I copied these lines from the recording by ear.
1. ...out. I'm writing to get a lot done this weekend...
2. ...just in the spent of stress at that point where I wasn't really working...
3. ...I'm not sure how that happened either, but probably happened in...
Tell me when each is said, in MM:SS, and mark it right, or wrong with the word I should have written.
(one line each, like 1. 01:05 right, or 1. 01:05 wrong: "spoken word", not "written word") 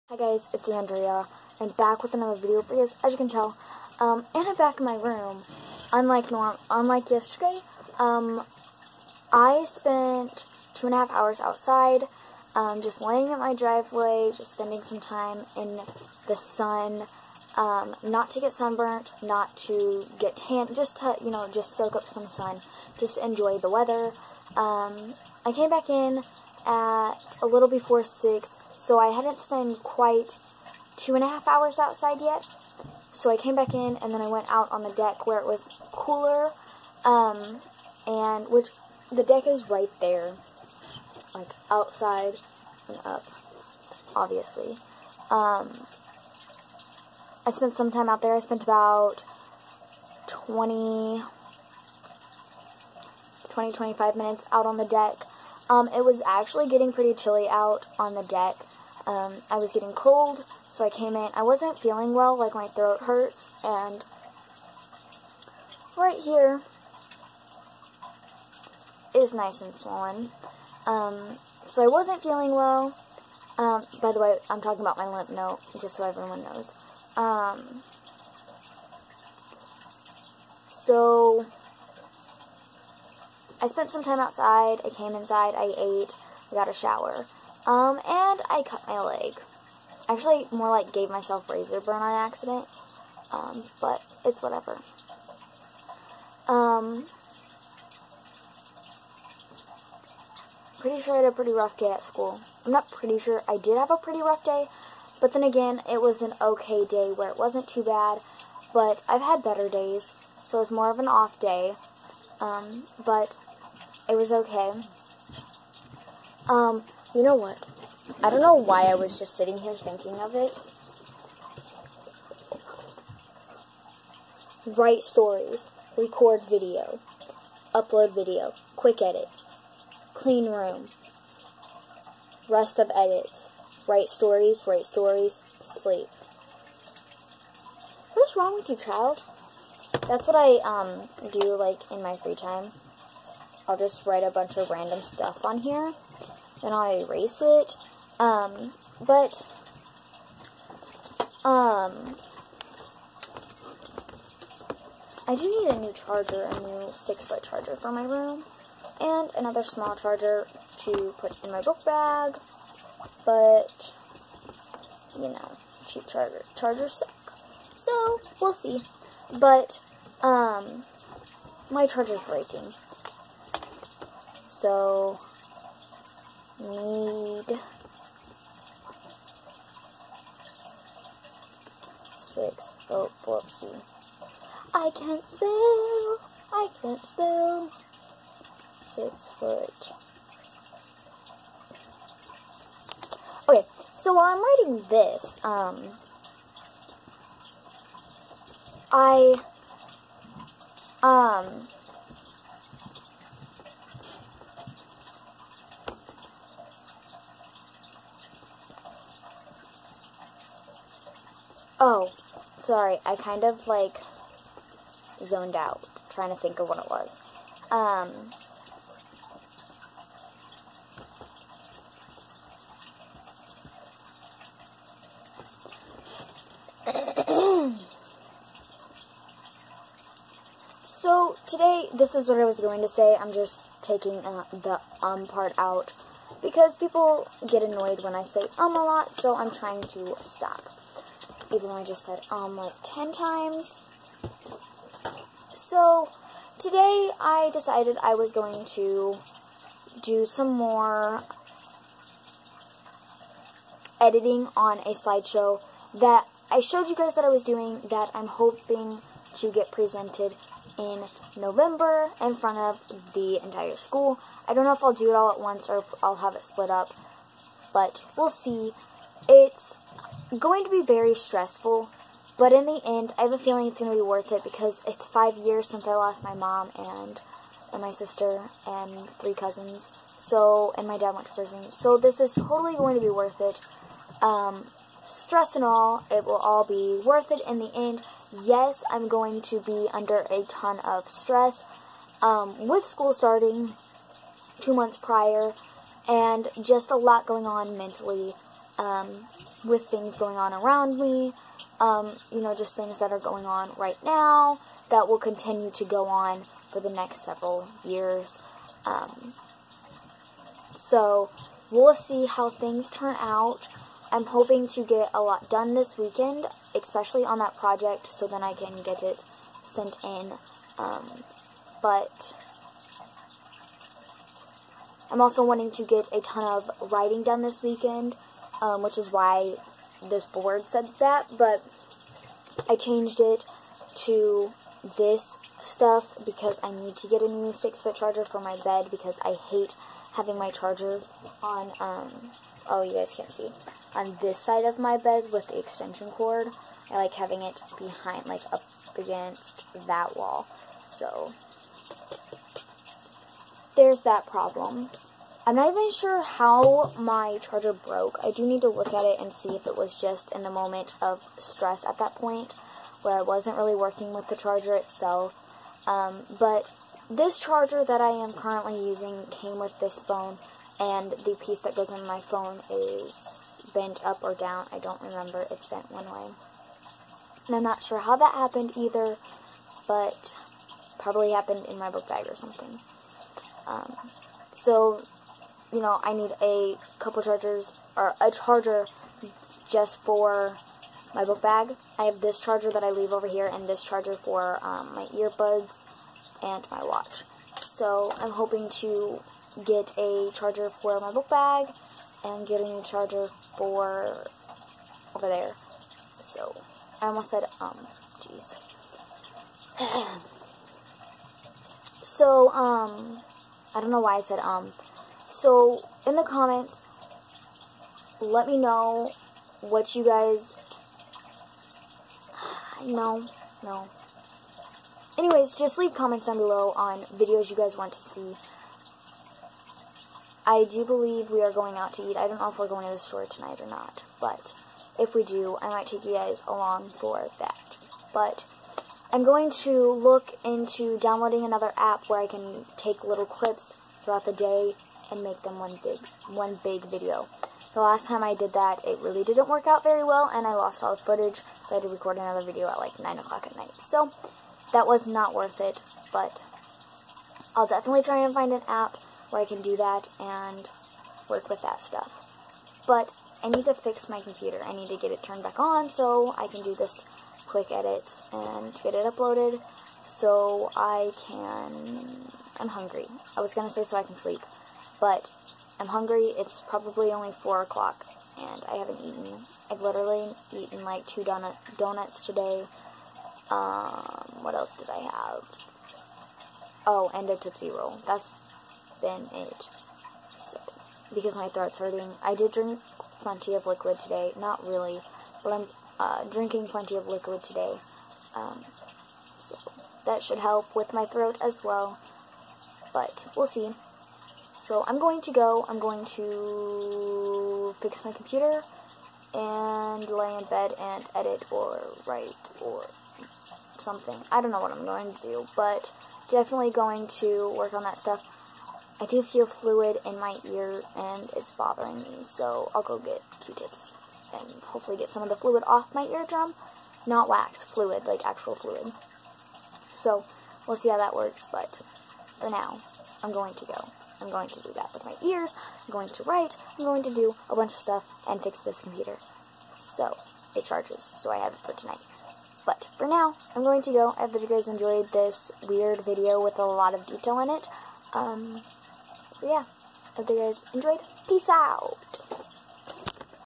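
1. 05:13 wrong: "hoping", not "writing"
2. 05:59 wrong: "moment", not "spent"
3. 06:17 right.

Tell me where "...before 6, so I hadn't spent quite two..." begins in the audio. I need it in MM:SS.
00:27.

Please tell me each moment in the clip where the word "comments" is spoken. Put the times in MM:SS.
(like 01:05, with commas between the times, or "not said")
06:56, 07:05.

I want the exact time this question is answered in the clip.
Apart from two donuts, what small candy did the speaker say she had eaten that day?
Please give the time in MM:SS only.
08:07.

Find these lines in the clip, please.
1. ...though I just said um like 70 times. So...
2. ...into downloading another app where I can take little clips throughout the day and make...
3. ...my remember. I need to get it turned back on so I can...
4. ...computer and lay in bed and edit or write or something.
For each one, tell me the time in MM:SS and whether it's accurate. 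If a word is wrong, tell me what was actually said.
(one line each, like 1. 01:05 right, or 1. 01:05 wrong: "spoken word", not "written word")
1. 04:01 wrong: "10", not "70"
2. 07:20 right
3. 07:44 wrong: "computer", not "remember"
4. 08:28 right.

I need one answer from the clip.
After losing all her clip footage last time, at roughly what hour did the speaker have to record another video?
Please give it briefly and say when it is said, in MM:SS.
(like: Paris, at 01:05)
9 o'clock, at 07:32.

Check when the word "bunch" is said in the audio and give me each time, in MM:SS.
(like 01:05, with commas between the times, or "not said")
02:24, 08:57.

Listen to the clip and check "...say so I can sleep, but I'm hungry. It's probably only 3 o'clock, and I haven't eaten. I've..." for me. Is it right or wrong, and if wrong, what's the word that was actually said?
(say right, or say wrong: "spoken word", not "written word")
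wrong: "4", not "3".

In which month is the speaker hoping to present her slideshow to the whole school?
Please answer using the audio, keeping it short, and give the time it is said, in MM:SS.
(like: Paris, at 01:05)
November, at 04:21.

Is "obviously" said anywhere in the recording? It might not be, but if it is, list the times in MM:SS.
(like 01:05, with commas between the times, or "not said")
00:44.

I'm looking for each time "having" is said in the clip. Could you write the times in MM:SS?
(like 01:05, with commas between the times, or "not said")
05:40, 05:47.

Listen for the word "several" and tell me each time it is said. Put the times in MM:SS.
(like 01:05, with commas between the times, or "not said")
05:07.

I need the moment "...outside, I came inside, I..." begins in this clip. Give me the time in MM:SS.
01:24.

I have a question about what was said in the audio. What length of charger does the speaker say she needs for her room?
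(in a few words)
6-foot.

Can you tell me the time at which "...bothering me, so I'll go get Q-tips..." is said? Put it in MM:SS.
08:41.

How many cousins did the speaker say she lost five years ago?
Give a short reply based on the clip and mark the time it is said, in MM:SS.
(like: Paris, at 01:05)
3, at 04:39.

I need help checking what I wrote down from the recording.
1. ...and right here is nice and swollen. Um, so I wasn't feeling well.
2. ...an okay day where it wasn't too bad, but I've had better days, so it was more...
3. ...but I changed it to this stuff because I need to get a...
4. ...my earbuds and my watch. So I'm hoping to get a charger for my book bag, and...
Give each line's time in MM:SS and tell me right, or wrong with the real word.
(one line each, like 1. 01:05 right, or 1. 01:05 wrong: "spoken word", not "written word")
1. 01:03 right
2. 01:46 right
3. 05:31 right
4. 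06:34 right.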